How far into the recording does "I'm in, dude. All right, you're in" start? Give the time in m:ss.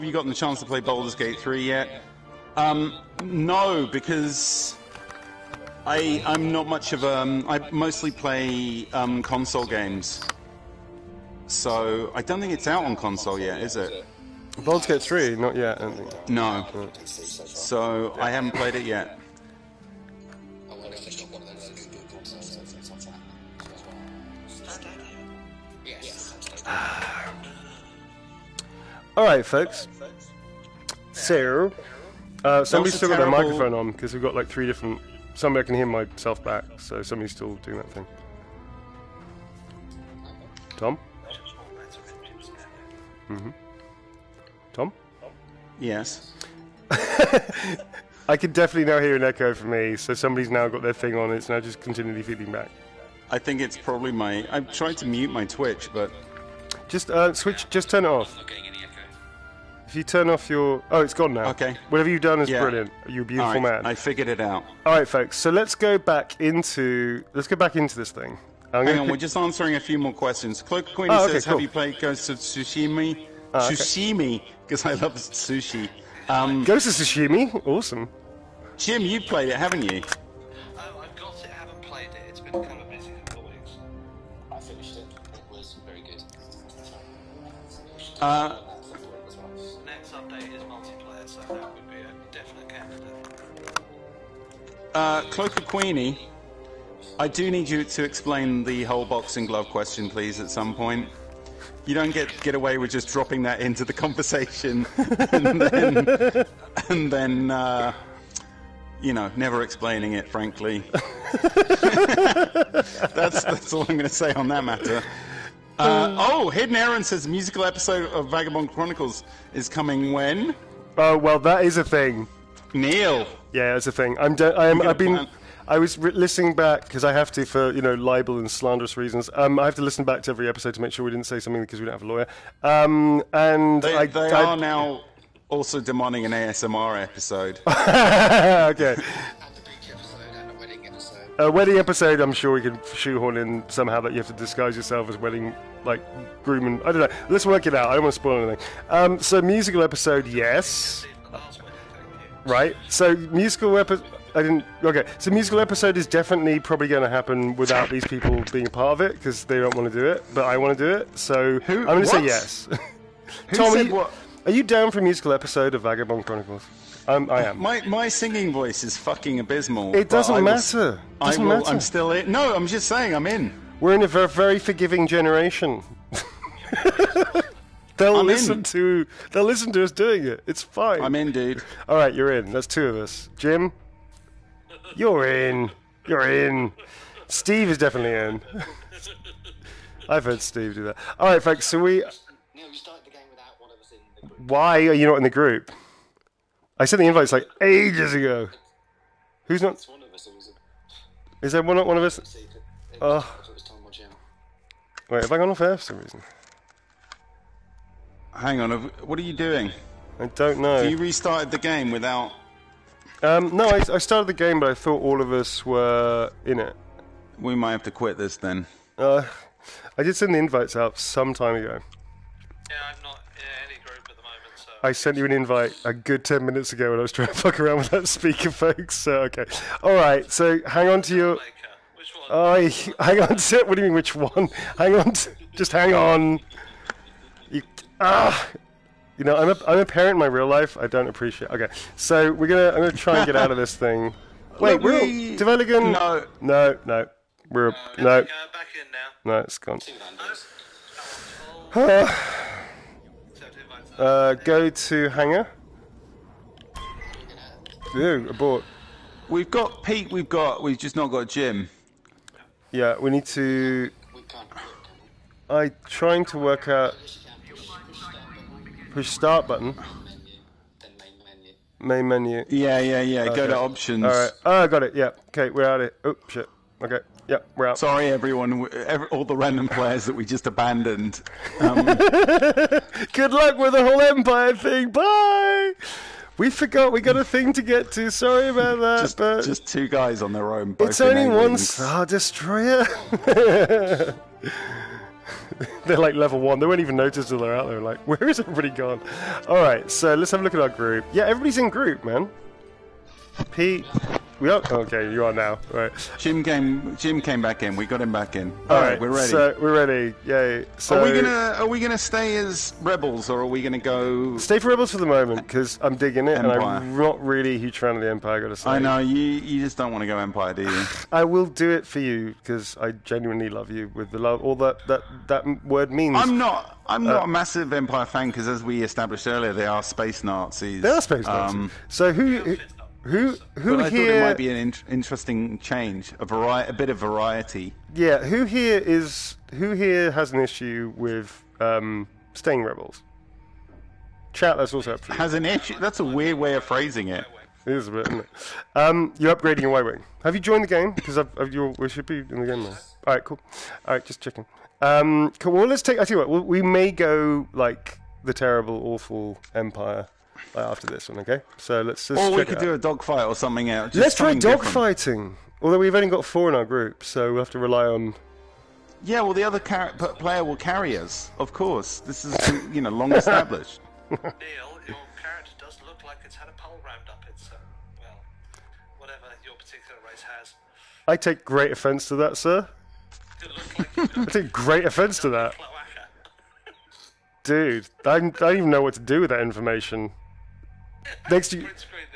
3:01.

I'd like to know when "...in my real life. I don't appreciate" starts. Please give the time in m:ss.
4:00.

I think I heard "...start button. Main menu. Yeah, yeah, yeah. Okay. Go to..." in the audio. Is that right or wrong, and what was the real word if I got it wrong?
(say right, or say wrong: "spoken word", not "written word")
right.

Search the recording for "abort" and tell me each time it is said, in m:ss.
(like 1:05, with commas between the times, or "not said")
4:18.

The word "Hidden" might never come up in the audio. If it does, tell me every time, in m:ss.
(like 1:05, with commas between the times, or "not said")
1:56.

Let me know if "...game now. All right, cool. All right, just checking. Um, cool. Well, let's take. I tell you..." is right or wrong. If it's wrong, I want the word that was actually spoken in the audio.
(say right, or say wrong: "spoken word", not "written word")
right.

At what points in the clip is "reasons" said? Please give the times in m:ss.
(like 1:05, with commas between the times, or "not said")
2:08, 3:25.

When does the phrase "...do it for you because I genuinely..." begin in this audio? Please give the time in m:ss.
5:21.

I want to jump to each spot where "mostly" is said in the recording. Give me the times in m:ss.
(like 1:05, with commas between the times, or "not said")
0:07.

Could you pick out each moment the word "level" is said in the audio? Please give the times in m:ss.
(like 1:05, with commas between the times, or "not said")
4:56.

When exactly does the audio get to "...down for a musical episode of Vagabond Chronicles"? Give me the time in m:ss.
2:44.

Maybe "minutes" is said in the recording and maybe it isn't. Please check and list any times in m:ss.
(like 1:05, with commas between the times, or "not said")
3:46.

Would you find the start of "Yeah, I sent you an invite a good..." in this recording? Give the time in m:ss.
3:42.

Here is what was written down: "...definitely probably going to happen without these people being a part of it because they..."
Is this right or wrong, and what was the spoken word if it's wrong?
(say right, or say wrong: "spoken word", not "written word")
right.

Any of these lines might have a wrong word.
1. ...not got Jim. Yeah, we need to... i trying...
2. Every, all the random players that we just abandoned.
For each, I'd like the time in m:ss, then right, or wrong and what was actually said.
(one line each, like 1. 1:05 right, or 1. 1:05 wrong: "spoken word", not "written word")
1. 4:20 right
2. 4:38 right.